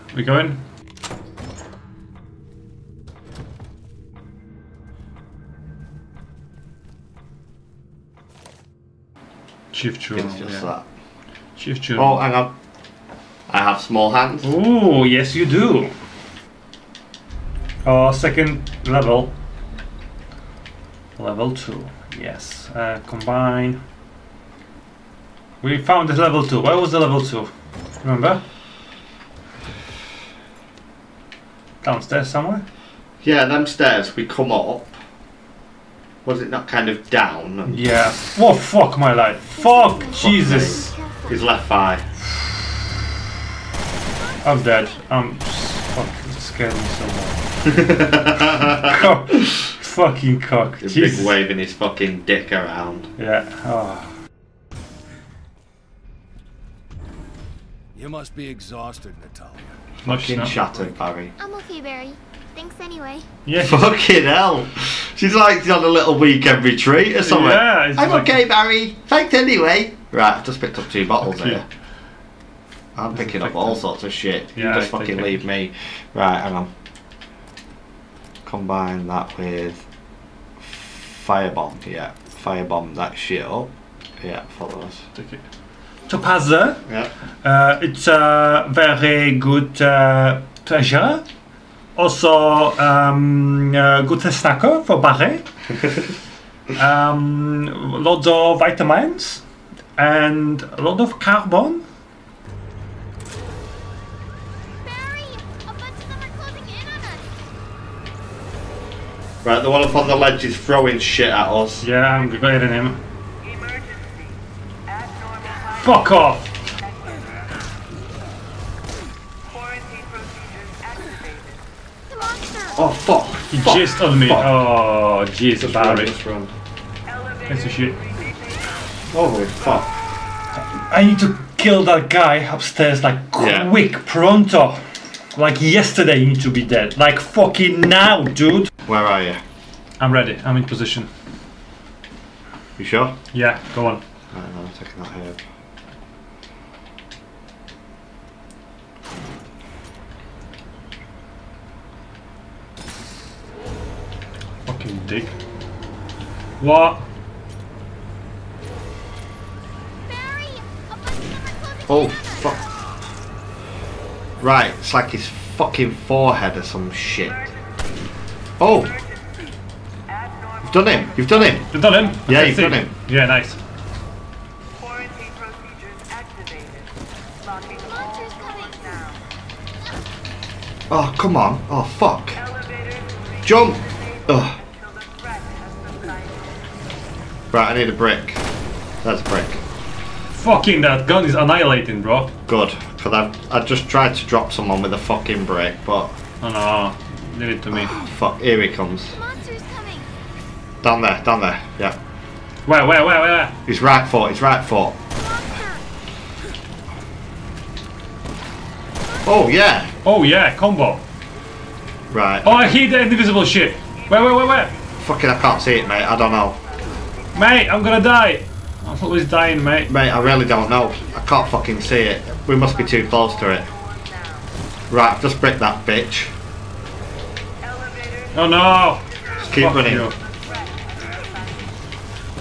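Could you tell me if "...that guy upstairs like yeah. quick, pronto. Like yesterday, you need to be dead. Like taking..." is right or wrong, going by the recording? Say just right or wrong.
wrong.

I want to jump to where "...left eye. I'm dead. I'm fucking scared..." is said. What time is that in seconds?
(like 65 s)
41 s.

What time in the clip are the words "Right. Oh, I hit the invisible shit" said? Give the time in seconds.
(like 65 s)
212 s.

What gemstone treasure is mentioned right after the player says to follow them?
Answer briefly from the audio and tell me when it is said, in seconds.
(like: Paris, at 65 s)
Topaz, at 86 s.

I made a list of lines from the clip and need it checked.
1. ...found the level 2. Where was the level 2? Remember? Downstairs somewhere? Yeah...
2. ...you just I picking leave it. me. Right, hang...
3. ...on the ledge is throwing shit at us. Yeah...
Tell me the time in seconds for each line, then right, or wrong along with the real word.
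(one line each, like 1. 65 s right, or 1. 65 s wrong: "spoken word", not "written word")
1. 25 s right
2. 74 s wrong: "fucking", not "picking"
3. 109 s right.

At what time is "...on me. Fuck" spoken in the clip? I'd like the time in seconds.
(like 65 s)
124 s.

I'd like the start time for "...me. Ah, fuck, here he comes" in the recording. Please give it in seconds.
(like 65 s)
197 s.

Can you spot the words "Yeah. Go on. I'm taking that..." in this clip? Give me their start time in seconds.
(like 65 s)
143 s.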